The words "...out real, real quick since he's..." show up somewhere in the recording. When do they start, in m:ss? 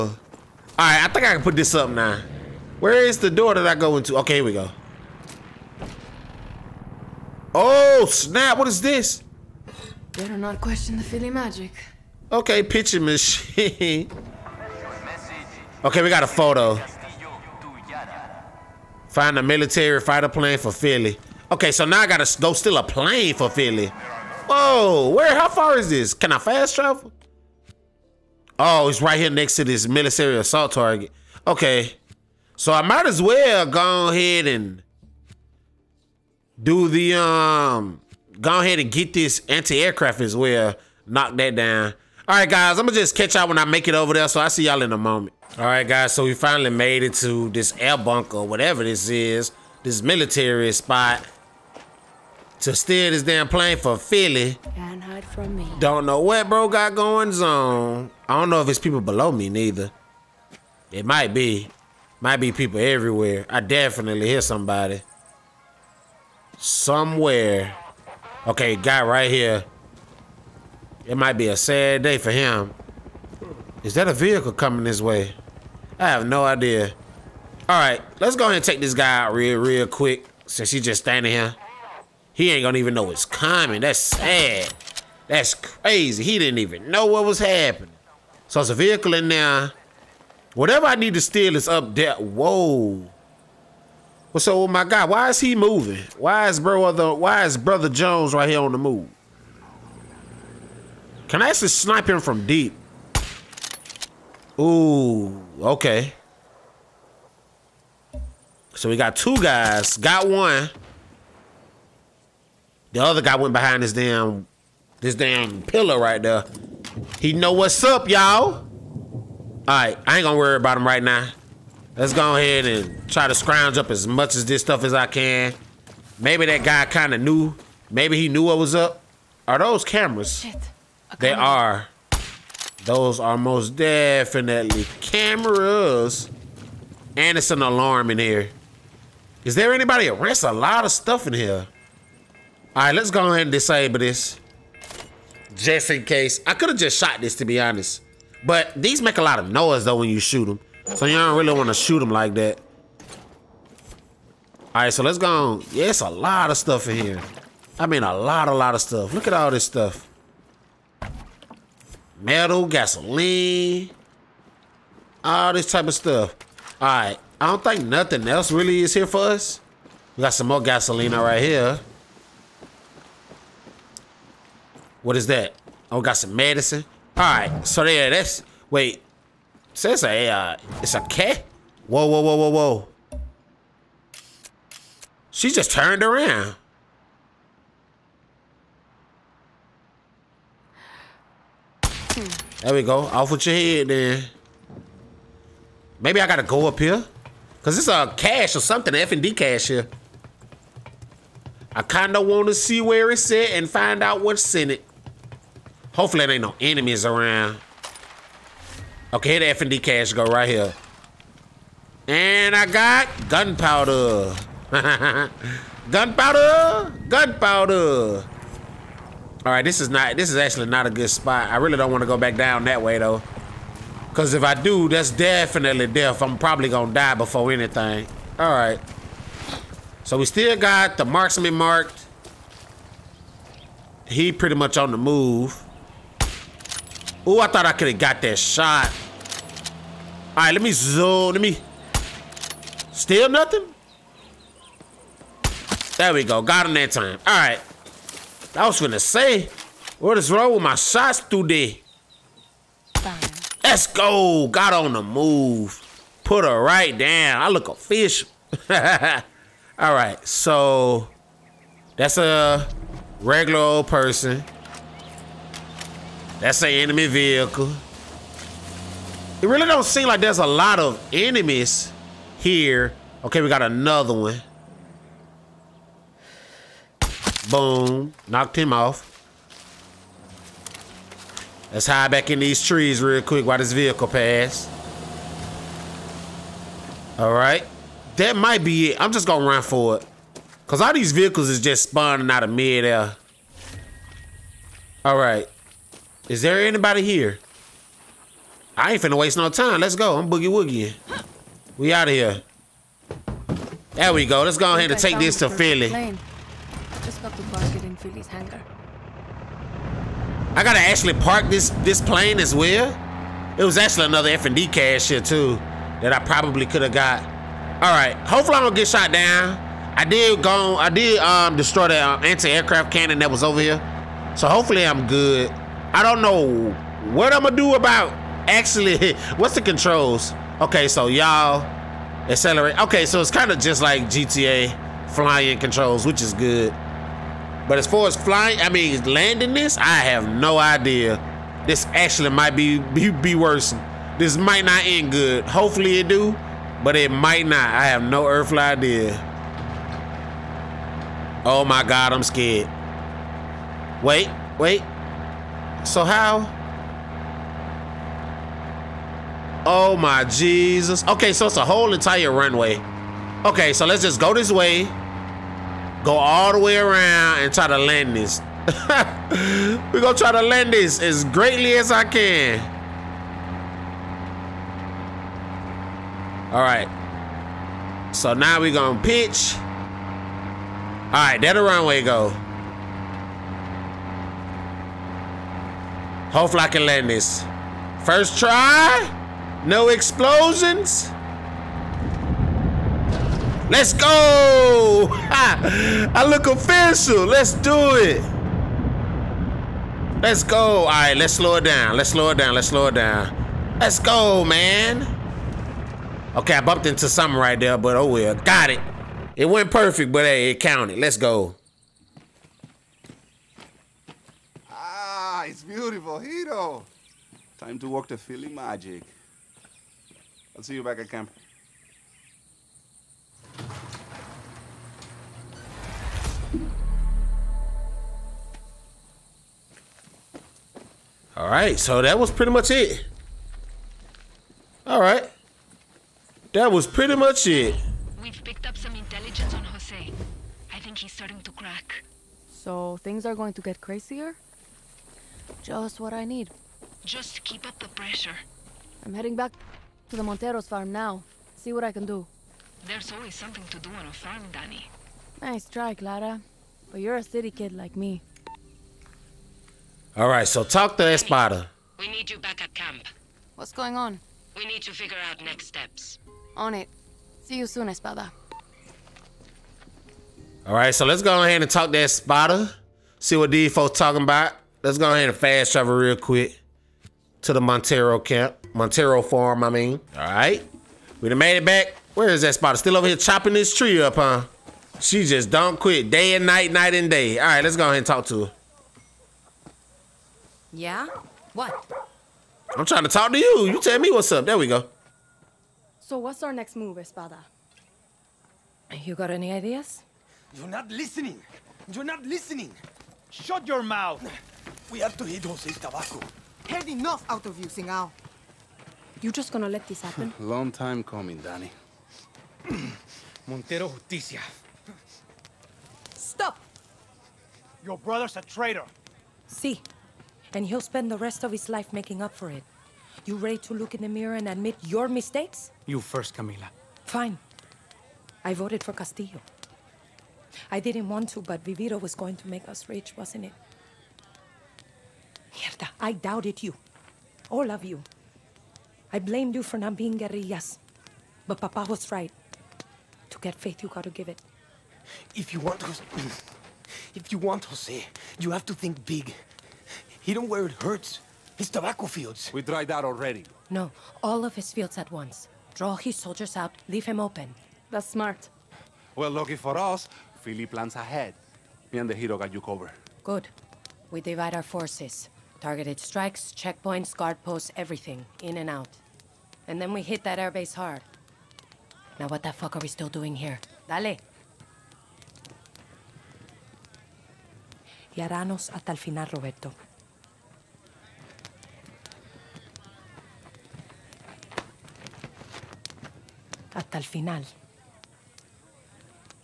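1:19.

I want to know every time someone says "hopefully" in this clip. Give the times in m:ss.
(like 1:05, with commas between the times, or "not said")
3:25, 5:18, 5:24, 5:45, 6:26.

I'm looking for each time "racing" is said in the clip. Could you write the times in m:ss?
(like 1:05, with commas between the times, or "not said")
not said.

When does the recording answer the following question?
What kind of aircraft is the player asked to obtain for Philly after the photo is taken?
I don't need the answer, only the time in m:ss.
0:19.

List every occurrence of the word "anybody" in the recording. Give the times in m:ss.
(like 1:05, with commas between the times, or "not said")
2:19, 4:56.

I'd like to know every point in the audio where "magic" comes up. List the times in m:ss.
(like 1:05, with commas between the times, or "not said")
0:11, 6:58.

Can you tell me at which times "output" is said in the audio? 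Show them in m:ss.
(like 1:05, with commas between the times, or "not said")
not said.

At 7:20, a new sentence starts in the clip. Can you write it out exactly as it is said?
I think he's starting to crack.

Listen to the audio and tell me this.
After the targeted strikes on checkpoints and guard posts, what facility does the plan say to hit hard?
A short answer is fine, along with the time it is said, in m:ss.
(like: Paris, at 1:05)
Airbase, at 9:30.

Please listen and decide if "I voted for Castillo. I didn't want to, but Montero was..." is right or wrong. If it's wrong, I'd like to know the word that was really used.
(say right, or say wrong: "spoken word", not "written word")
wrong: "Viviro", not "Montero".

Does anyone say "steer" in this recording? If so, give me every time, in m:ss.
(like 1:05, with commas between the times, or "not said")
0:52.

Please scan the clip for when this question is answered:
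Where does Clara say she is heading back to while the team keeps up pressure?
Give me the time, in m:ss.
7:30.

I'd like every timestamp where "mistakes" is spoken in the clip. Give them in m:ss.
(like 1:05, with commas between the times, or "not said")
8:45.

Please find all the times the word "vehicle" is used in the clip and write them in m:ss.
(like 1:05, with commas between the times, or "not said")
1:14, 1:28, 4:27, 4:43, 4:51.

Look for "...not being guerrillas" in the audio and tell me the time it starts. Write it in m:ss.
8:59.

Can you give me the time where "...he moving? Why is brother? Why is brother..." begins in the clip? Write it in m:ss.
1:35.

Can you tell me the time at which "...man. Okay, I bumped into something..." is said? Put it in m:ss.
6:44.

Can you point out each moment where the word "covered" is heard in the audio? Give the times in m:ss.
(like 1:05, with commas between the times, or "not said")
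9:22.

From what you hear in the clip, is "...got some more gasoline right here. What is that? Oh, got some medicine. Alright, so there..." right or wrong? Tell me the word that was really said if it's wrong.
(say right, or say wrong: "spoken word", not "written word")
right.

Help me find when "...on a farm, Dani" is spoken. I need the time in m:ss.
7:33.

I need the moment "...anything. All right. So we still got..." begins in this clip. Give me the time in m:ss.
3:47.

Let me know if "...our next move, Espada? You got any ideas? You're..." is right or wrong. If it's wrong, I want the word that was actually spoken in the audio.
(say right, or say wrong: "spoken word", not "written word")
right.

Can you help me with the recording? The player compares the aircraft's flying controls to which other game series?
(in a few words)
GTA.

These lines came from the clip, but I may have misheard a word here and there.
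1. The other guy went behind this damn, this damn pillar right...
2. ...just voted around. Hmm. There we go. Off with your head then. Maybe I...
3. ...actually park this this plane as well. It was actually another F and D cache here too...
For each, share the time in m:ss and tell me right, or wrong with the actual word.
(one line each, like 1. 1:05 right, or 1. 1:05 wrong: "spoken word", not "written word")
1. 1:52 right
2. 3:05 wrong: "turned", not "voted"
3. 5:10 right.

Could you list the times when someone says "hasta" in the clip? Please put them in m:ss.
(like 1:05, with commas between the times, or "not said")
9:38, 9:46.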